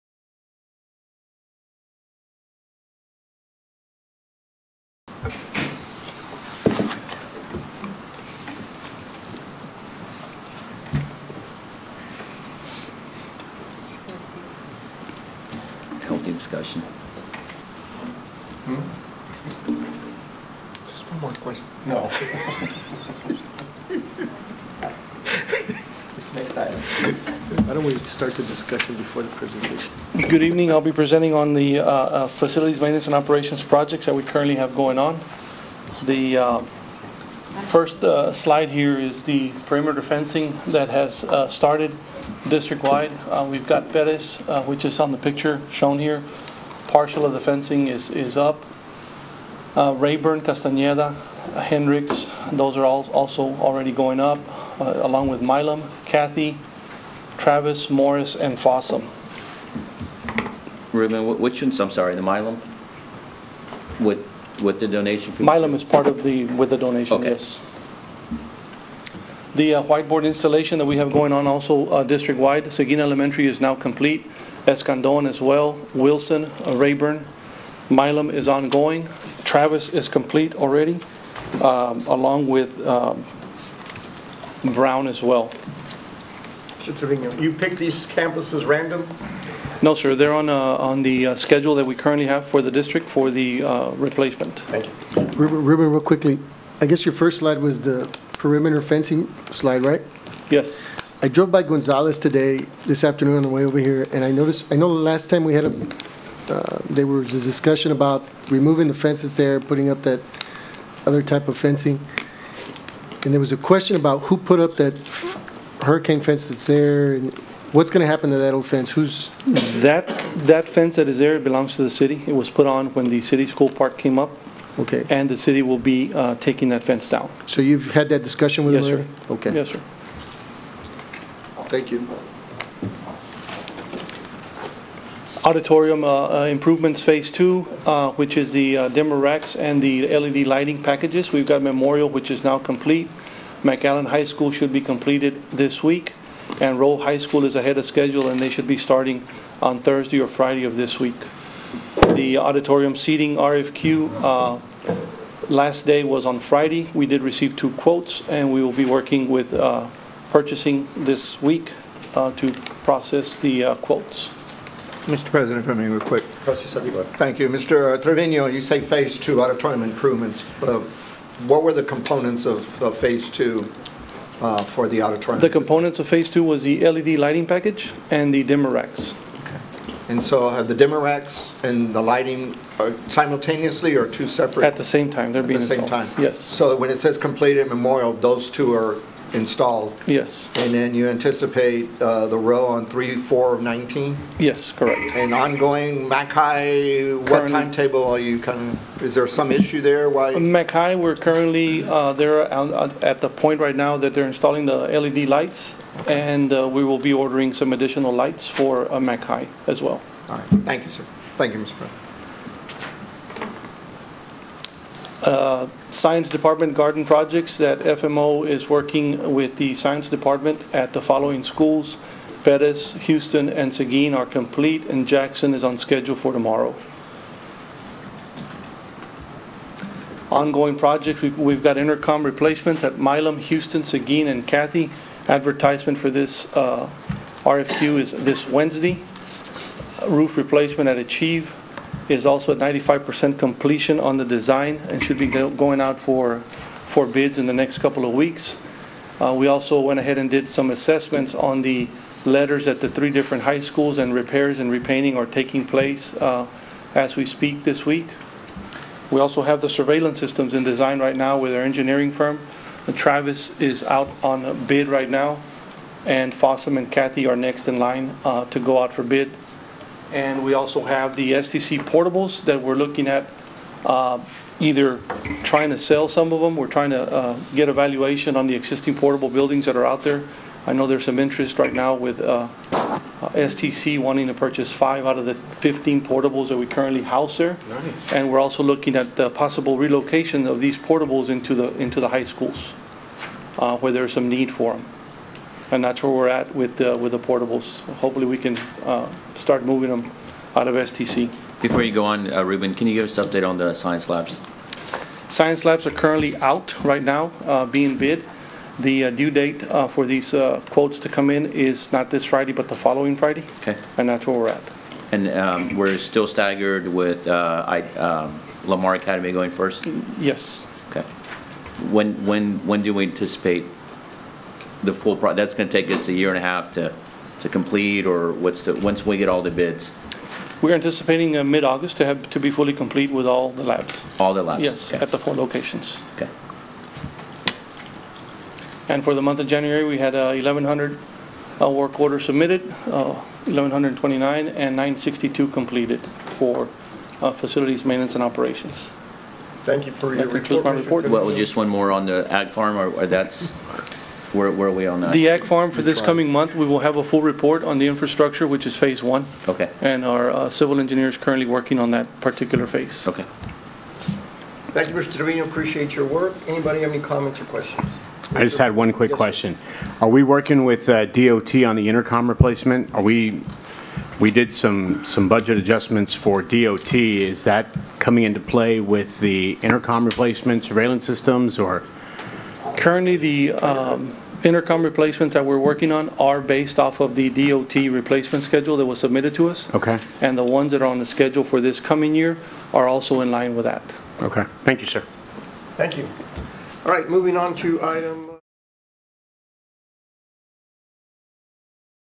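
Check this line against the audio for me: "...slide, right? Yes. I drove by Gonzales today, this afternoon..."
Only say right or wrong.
right.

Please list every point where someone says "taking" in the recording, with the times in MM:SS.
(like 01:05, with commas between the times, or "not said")
02:06, 04:15.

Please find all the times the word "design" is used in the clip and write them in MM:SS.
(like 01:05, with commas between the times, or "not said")
04:04, 04:20.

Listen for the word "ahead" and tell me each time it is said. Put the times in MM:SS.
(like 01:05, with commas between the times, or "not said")
02:27, 04:09.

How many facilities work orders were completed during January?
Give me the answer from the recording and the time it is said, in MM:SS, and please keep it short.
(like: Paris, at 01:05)
962, at 05:44.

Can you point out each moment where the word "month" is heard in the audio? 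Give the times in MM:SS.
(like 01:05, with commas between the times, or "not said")
05:39, 05:56.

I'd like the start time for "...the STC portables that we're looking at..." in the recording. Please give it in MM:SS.
04:31.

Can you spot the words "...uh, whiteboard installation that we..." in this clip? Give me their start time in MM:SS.
01:09.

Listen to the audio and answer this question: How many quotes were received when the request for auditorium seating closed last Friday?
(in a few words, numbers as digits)
2.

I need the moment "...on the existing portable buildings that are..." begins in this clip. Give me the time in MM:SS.
04:38.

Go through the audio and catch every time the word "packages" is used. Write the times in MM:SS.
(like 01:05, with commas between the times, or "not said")
02:20, 02:57.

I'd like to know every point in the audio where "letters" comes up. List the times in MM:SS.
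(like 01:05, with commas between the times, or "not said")
04:12.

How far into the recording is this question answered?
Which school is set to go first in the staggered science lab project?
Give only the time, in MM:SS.
05:18.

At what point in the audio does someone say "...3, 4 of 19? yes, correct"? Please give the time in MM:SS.
03:12.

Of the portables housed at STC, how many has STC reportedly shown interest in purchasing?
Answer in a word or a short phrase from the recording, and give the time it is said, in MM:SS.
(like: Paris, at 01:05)
5, at 04:44.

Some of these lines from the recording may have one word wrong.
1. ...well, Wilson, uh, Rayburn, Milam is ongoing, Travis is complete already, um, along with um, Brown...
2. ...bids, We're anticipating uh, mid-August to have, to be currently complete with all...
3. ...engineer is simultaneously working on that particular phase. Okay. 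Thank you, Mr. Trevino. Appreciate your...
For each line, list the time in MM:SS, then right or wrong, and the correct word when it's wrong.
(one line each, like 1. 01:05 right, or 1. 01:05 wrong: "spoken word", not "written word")
1. 01:15 right
2. 05:29 wrong: "fully", not "currently"
3. 06:00 wrong: "currently", not "simultaneously".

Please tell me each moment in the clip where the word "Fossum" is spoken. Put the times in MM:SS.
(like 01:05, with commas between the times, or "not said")
00:58, 04:26.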